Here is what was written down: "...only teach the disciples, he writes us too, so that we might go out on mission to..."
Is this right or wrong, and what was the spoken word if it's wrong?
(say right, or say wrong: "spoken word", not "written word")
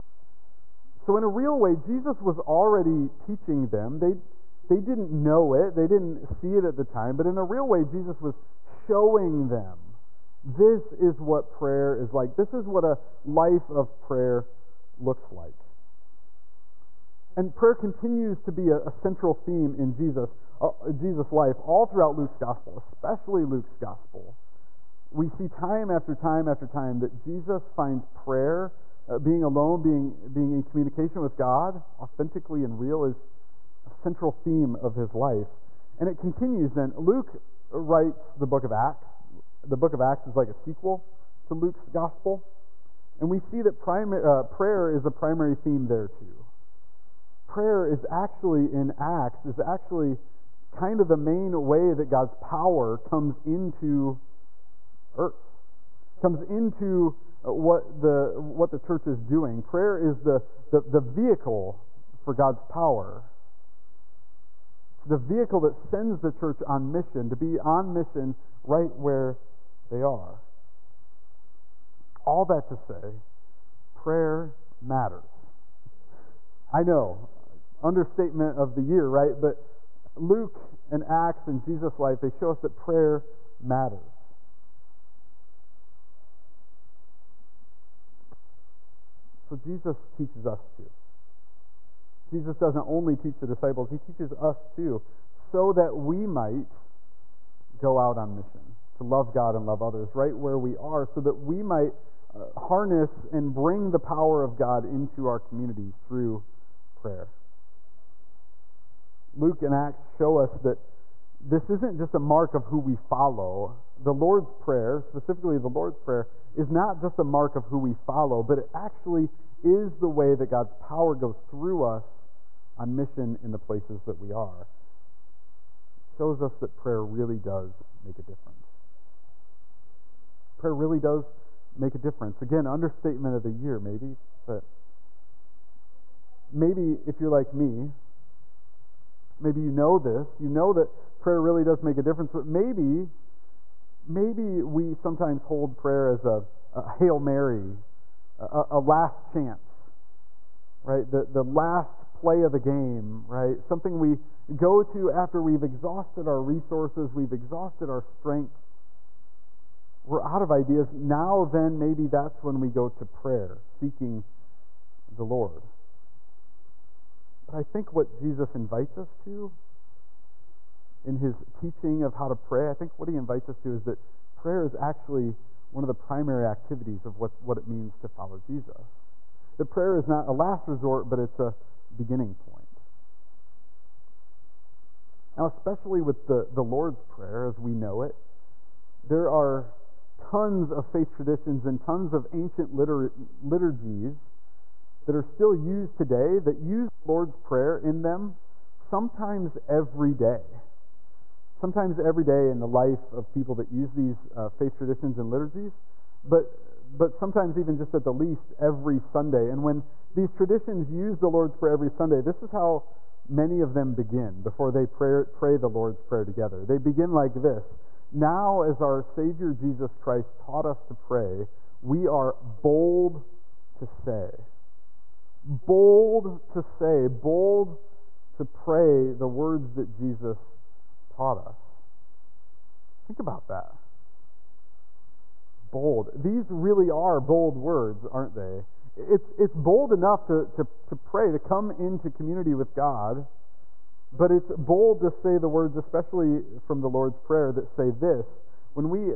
wrong: "teaches", not "writes".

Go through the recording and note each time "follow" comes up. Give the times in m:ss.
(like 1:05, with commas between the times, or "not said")
1:52, 1:57, 2:58.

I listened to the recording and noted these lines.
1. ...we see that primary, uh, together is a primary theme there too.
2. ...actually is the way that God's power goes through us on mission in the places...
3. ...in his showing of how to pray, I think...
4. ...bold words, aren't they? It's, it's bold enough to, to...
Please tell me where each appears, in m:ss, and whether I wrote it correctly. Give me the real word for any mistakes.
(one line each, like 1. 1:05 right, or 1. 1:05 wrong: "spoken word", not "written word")
1. 0:43 wrong: "prayer", not "together"
2. 1:58 right
3. 2:51 wrong: "teaching", not "showing"
4. 3:57 right.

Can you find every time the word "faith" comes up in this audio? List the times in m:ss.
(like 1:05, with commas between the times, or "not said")
3:10, 3:24.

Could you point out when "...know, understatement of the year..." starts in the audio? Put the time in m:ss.
1:16.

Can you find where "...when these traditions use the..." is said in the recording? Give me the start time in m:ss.
3:29.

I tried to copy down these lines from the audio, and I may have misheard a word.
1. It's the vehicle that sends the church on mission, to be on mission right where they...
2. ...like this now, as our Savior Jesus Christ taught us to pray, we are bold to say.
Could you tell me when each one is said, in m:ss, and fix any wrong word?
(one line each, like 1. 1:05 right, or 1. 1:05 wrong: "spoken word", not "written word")
1. 1:04 right
2. 3:37 right.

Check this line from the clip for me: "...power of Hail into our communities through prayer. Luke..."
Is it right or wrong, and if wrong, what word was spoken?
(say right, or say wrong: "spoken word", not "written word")
wrong: "God", not "Hail".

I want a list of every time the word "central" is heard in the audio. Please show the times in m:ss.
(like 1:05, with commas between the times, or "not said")
0:18, 0:33.